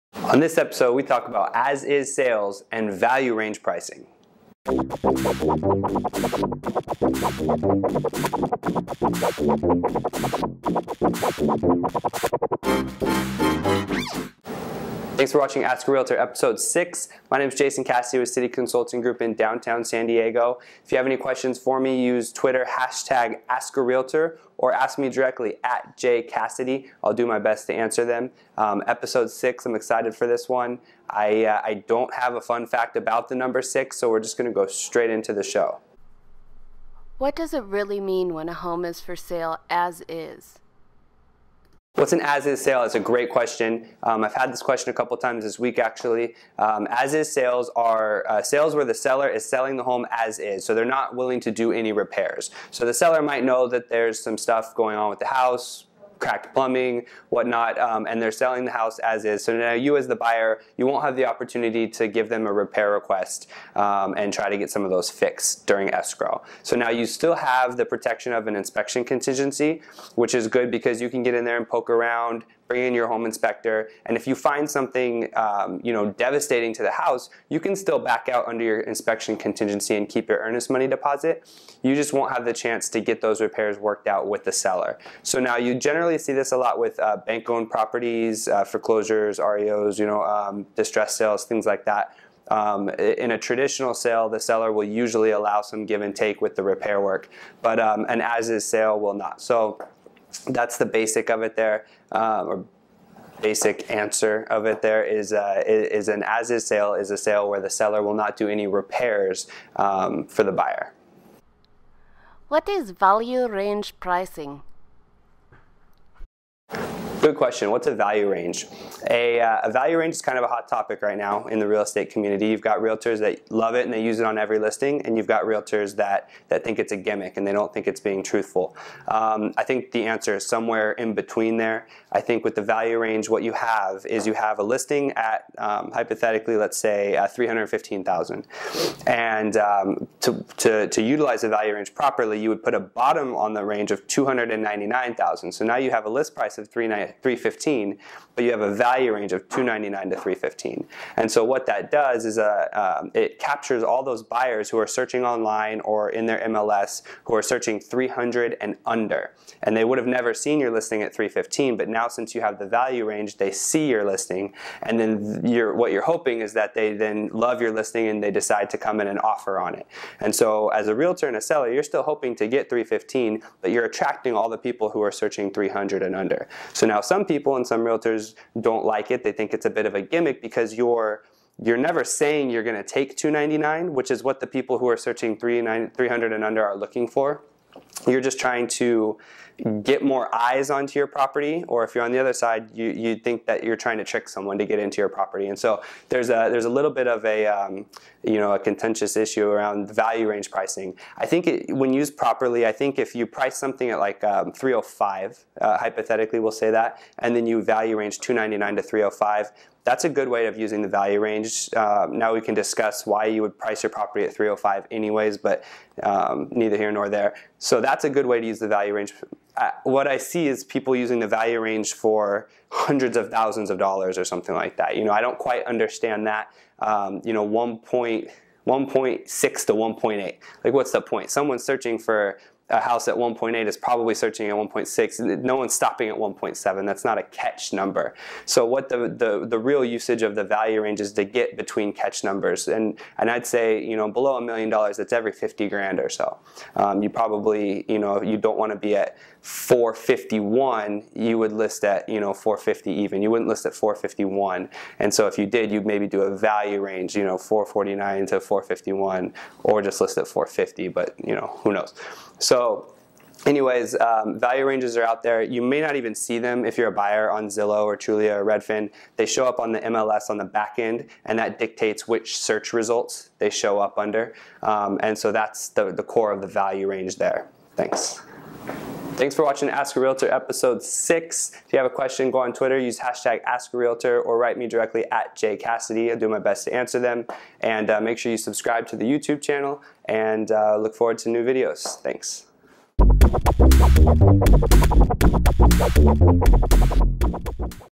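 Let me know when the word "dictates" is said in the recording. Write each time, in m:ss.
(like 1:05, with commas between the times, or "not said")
4:31.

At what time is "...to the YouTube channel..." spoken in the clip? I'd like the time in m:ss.
4:48.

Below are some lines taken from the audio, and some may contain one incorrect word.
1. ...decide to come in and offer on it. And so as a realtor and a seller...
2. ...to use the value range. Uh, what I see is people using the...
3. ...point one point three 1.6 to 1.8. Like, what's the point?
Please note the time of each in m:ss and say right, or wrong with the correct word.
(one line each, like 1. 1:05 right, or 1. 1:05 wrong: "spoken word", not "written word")
1. 2:48 right
2. 3:38 right
3. 3:47 wrong: "six", not "three".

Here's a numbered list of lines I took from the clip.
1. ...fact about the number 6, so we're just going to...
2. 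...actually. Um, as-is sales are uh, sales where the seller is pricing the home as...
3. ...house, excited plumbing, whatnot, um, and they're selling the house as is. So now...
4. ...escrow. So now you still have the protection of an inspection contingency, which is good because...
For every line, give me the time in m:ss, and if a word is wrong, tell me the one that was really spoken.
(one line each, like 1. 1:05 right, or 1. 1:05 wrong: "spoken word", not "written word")
1. 0:32 right
2. 0:45 wrong: "selling", not "pricing"
3. 0:55 wrong: "cracked", not "excited"
4. 1:05 right.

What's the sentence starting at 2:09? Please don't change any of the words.
Um, I think the answer is somewhere in between there.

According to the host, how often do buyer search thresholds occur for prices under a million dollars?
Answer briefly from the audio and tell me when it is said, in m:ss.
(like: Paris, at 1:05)
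every 50 grand, at 4:05.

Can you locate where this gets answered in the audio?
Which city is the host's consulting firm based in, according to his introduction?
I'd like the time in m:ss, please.
0:19.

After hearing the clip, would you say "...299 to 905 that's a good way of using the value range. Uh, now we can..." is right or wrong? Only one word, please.
wrong.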